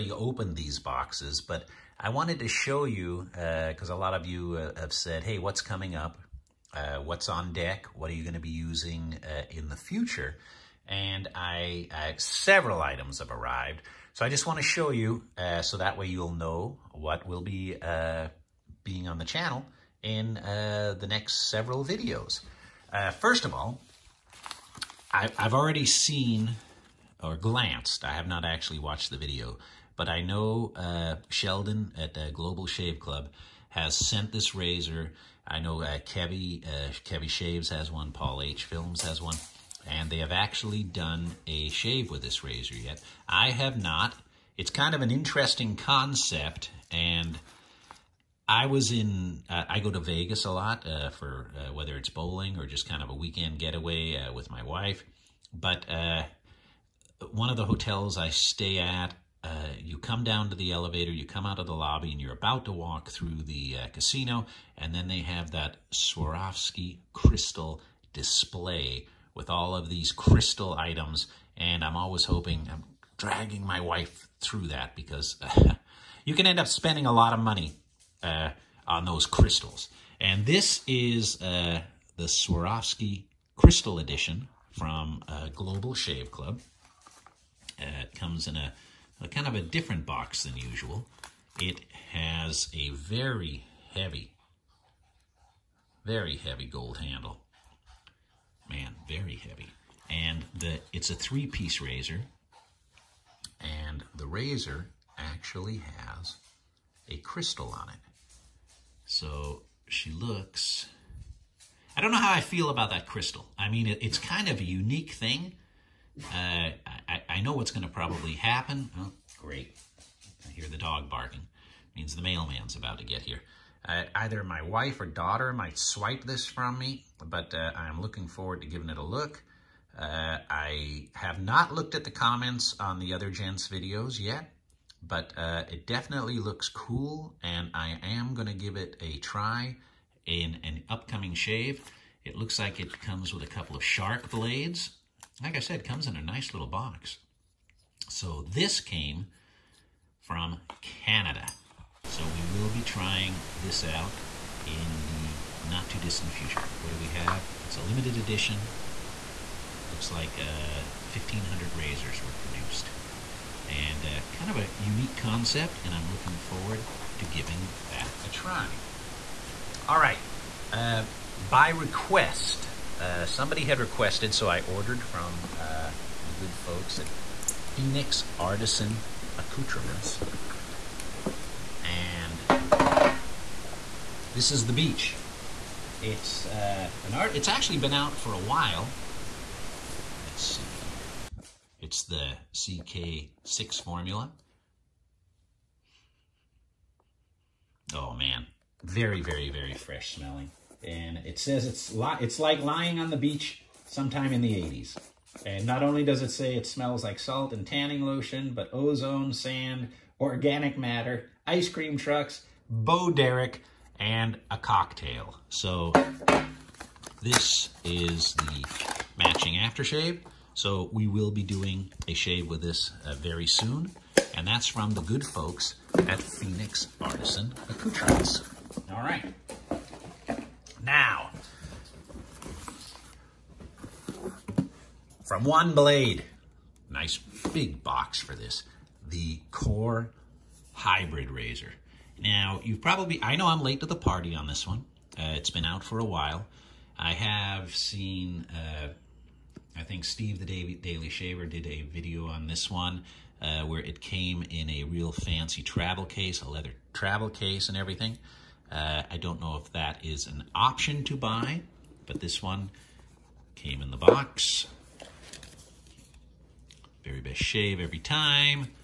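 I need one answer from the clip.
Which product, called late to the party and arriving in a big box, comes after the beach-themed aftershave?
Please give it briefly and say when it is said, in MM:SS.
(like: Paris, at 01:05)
Core Hybrid Razor, at 03:59.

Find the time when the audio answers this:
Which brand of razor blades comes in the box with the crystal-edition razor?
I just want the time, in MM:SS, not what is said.
02:23.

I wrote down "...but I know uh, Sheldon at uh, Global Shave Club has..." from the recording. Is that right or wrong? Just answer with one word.
right.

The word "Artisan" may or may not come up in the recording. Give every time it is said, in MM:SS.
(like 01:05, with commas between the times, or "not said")
02:58, 03:47.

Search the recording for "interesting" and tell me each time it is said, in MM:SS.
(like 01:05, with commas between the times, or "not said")
00:45.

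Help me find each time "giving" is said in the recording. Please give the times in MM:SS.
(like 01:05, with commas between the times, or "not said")
02:08, 02:47.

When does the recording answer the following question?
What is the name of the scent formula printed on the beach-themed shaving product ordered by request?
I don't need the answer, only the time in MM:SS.
03:12.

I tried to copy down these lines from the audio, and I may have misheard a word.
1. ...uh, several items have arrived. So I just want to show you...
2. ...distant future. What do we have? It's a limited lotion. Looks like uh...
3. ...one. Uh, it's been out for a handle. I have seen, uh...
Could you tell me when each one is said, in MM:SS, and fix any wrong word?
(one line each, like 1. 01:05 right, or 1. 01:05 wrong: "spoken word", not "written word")
1. 00:12 right
2. 02:35 wrong: "edition", not "lotion"
3. 04:04 wrong: "while", not "handle".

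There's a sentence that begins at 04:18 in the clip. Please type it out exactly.
Uh, I don't know if that is an option to buy, but this one came in the box.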